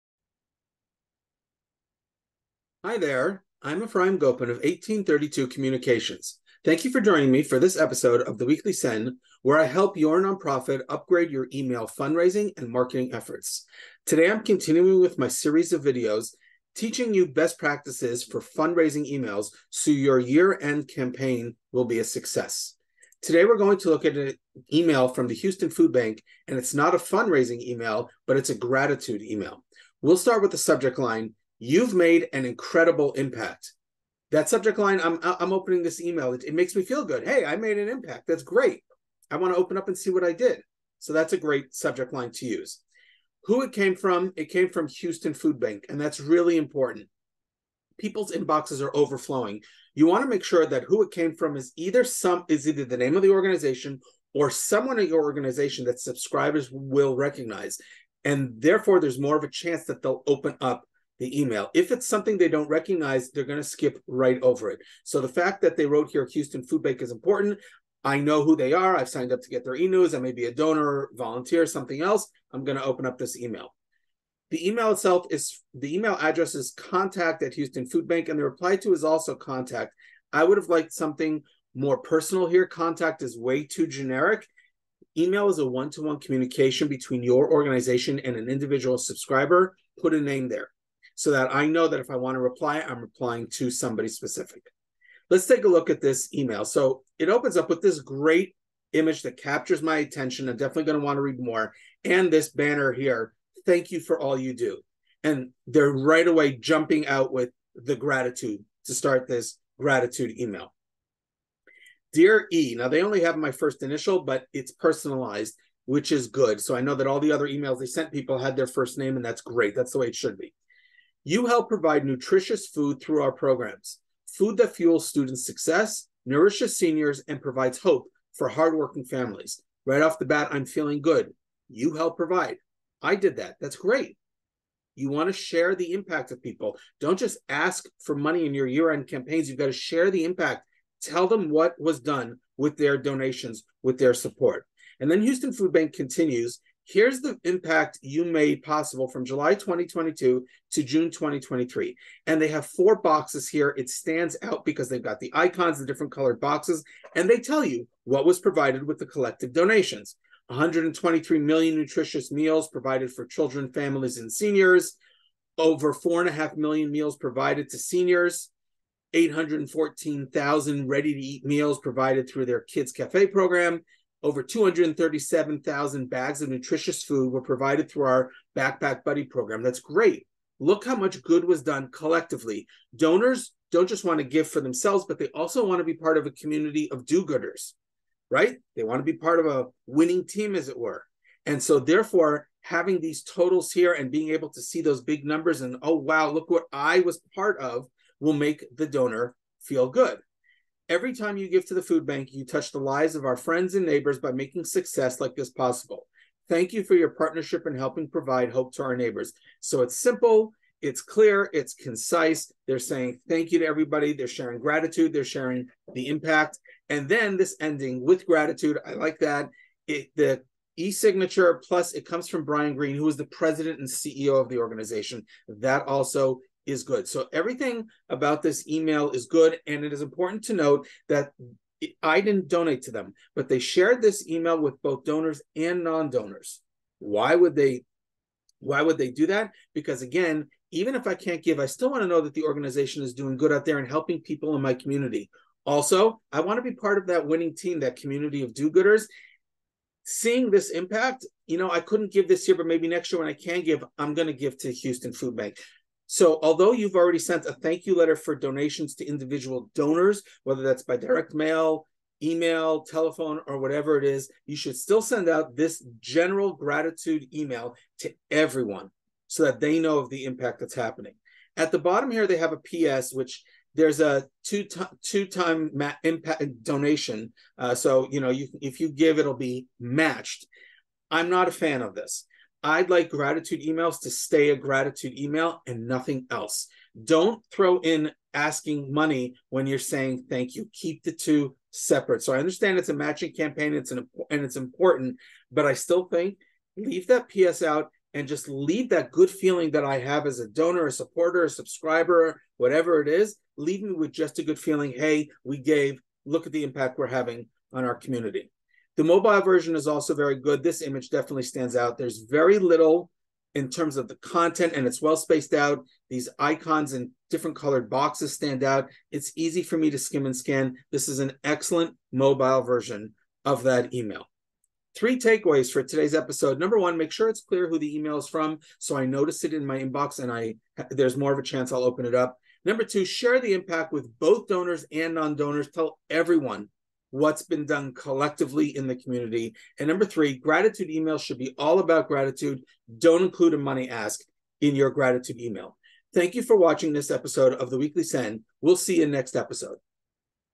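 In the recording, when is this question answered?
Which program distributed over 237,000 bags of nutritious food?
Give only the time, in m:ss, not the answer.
2:58.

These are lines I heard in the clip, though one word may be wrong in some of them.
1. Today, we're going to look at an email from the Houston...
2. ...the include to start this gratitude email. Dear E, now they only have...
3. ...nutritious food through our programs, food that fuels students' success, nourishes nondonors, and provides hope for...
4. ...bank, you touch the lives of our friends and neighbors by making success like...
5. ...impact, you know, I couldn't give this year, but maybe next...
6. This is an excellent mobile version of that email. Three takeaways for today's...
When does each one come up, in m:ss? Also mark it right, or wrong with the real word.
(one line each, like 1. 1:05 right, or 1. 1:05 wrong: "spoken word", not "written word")
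1. 0:23 right
2. 1:47 wrong: "gratitude", not "include"
3. 2:02 wrong: "seniors", not "nondonors"
4. 3:22 right
5. 4:10 right
6. 5:20 right.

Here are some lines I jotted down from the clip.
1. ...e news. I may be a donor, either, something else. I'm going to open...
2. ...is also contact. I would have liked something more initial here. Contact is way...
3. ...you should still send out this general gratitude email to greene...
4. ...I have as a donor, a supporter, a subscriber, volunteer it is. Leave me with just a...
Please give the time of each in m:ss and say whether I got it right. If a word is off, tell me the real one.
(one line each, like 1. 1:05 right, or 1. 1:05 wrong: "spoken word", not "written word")
1. 1:09 wrong: "volunteer", not "either"
2. 1:18 wrong: "personal", not "initial"
3. 4:24 wrong: "everyone", not "greene"
4. 4:59 wrong: "whatever", not "volunteer".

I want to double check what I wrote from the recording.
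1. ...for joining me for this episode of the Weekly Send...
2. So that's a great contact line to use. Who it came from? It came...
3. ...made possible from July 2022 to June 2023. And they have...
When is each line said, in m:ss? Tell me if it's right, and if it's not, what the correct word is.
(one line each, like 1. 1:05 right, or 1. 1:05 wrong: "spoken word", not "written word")
1. 0:06 right
2. 0:40 wrong: "subject", not "contact"
3. 2:28 right.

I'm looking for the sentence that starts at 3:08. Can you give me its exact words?
They want to be part of a winning team, as it were.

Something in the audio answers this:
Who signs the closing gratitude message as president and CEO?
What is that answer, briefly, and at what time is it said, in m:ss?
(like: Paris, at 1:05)
Brian Greene, at 3:42.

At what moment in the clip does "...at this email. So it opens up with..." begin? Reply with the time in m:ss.
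1:35.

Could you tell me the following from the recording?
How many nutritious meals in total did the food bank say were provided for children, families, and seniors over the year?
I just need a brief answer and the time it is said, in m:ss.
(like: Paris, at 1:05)
123 million, at 2:40.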